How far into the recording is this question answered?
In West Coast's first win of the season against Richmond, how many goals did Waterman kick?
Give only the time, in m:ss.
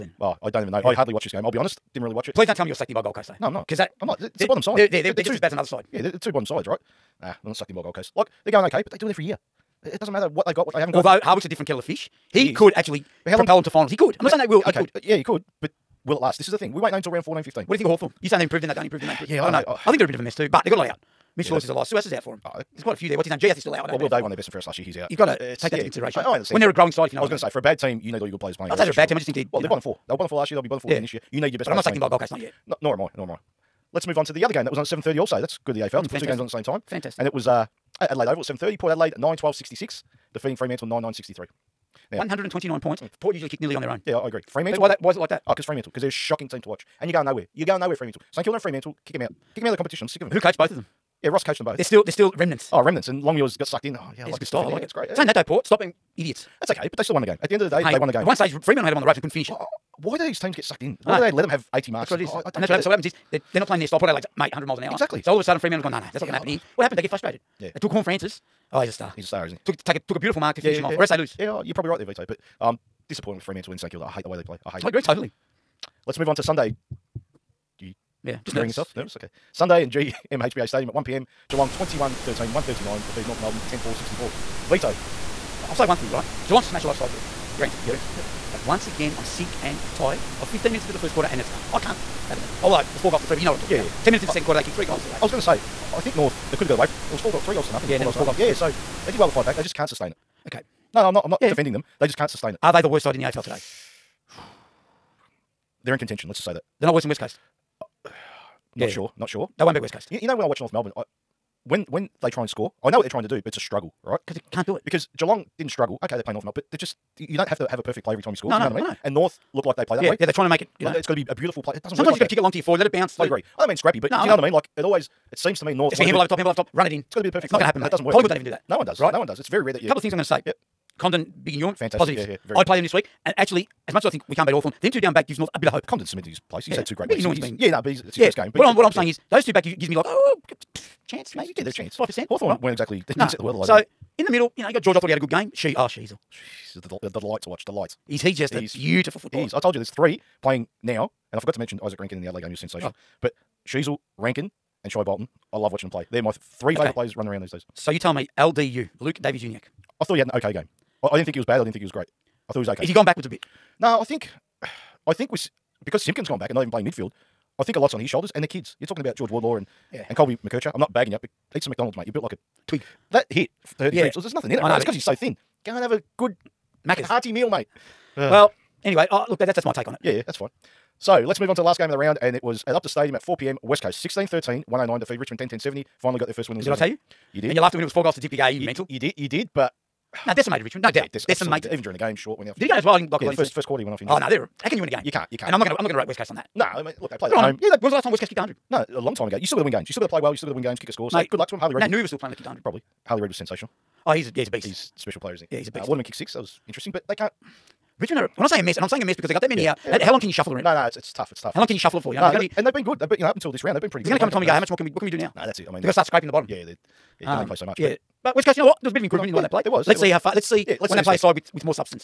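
3:26.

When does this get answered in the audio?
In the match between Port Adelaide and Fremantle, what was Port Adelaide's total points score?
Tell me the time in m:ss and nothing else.
0:39.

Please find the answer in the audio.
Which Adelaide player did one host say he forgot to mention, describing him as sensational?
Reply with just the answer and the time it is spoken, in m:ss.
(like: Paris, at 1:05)
Izak Rankine, at 2:31.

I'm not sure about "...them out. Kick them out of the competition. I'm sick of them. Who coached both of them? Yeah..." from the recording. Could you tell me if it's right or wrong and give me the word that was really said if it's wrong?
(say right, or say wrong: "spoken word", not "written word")
right.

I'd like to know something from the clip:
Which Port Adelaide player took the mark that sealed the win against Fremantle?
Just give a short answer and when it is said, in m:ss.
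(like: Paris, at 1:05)
Horne-Francis, at 1:07.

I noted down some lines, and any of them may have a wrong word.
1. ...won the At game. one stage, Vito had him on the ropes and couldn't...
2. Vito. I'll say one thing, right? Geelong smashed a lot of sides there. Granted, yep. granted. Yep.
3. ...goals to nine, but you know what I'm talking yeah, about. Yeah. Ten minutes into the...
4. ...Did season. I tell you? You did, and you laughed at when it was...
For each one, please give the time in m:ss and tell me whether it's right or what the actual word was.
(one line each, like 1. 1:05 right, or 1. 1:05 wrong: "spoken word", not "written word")
1. 0:57 wrong: "Fremantle", not "Vito"
2. 1:24 right
3. 1:33 wrong: "three", not "nine"
4. 3:06 right.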